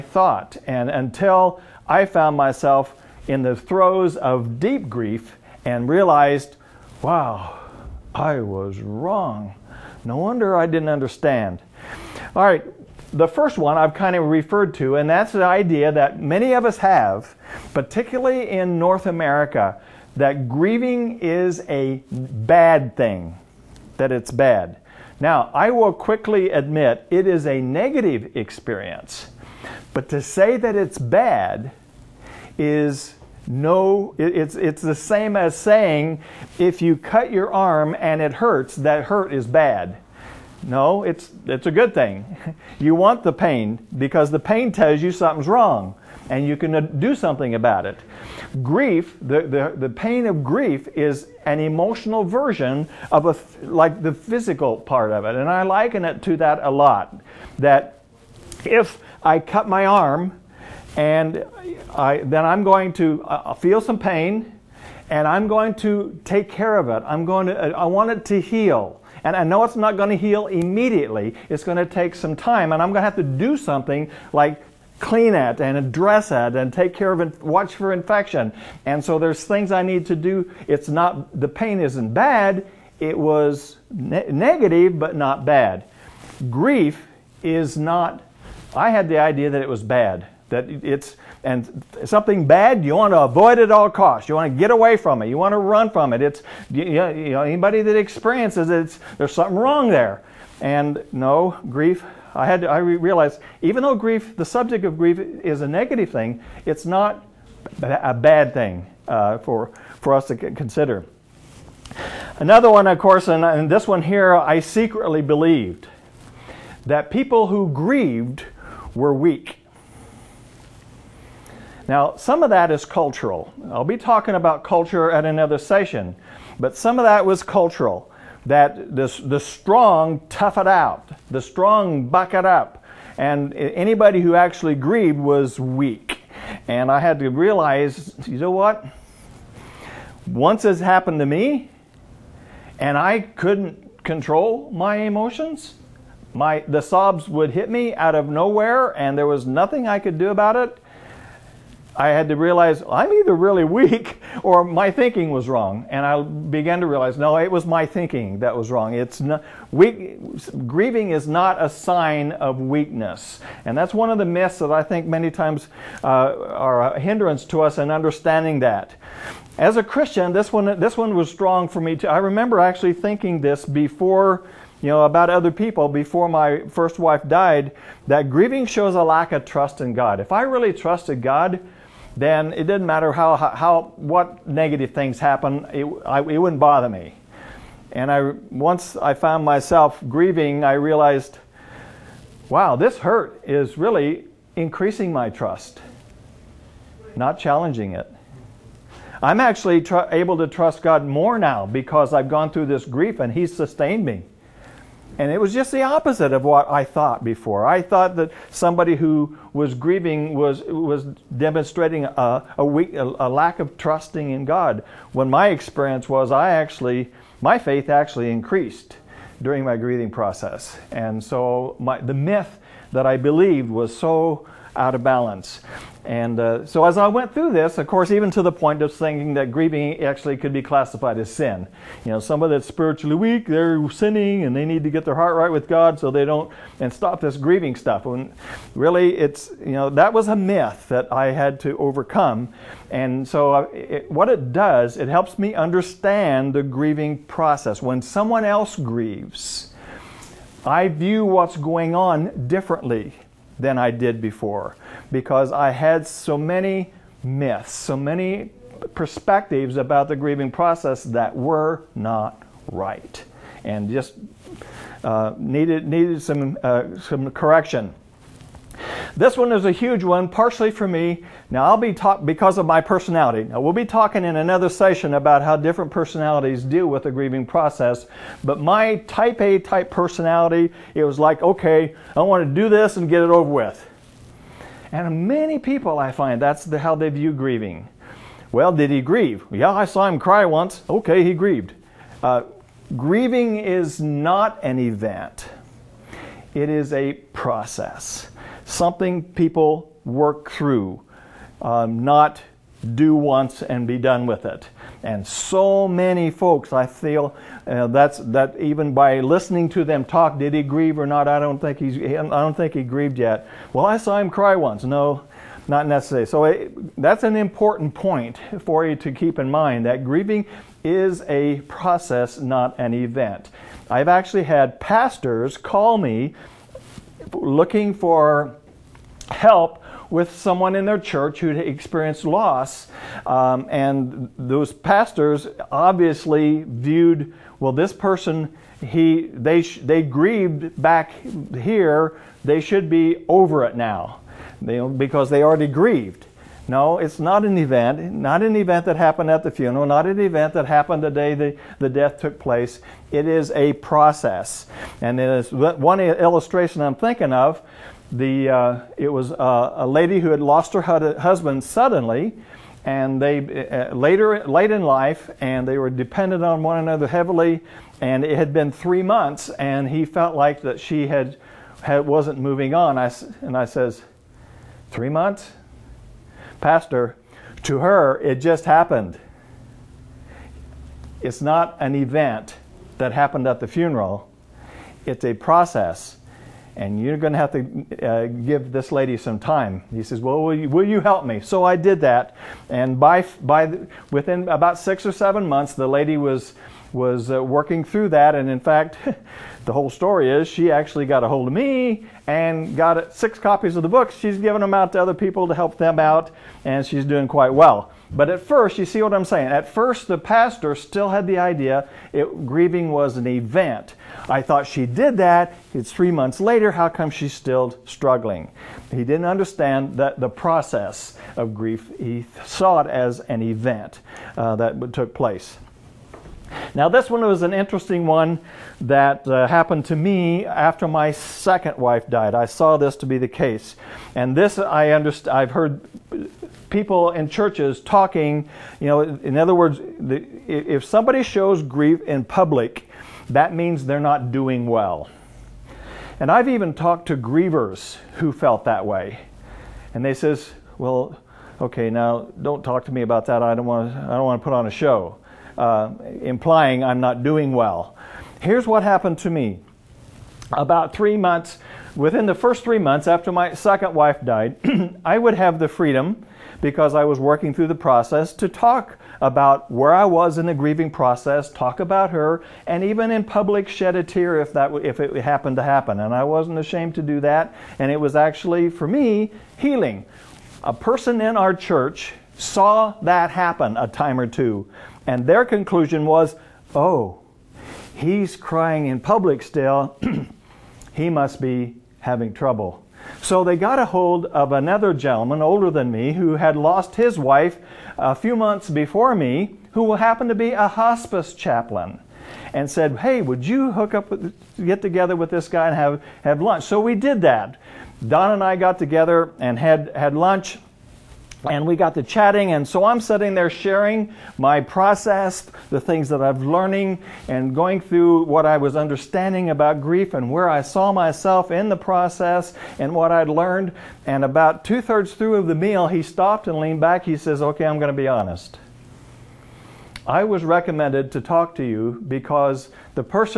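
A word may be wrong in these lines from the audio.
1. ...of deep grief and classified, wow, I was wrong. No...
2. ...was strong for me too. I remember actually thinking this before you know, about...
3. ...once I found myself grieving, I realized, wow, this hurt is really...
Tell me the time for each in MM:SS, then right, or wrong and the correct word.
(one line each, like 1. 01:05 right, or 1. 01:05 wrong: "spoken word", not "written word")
1. 00:04 wrong: "realized", not "classified"
2. 02:51 right
3. 03:08 right.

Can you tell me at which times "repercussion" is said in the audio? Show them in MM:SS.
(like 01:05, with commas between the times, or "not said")
not said.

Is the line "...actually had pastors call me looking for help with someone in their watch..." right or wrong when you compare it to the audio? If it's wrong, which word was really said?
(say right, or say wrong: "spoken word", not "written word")
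wrong: "church", not "watch".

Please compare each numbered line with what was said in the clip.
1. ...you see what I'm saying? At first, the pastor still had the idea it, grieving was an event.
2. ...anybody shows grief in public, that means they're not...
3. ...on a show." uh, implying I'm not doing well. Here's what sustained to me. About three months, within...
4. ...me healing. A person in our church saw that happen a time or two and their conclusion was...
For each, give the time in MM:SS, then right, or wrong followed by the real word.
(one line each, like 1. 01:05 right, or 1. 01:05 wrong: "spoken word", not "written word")
1. 06:48 right
2. 07:20 wrong: "somebody", not "anybody"
3. 07:34 wrong: "happened", not "sustained"
4. 07:58 right.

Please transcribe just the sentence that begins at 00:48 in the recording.
Grief, the, the, the pain of grief is an emotional version of a, like the physical part of it.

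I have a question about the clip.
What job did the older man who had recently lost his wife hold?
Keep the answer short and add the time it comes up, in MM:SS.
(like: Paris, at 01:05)
Hospice chaplain, at 08:20.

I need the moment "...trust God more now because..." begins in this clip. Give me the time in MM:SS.
03:20.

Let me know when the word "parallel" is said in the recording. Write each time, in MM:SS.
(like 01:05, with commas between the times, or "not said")
not said.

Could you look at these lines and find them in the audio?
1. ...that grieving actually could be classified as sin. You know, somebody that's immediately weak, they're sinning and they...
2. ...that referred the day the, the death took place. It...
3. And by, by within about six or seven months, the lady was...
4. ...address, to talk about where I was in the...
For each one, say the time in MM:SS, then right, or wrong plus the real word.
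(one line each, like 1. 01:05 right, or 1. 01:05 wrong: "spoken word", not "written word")
1. 03:49 wrong: "spiritually", not "immediately"
2. 05:50 wrong: "happened", not "referred"
3. 06:32 right
4. 07:47 wrong: "process", not "address".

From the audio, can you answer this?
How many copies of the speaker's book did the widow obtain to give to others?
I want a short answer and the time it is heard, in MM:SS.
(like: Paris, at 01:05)
6, at 06:43.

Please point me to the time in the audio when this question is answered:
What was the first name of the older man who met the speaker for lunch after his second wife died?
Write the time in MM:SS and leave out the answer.
08:28.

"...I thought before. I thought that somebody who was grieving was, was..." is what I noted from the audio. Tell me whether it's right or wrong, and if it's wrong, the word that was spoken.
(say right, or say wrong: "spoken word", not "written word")
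right.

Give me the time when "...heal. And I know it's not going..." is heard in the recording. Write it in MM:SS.
01:08.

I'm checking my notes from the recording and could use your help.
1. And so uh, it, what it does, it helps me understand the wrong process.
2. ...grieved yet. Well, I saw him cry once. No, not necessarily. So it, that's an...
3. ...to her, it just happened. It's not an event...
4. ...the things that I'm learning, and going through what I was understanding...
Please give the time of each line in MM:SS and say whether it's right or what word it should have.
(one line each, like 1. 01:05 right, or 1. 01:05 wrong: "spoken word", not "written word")
1. 04:02 wrong: "grieving", not "wrong"
2. 05:12 right
3. 06:17 right
4. 08:35 right.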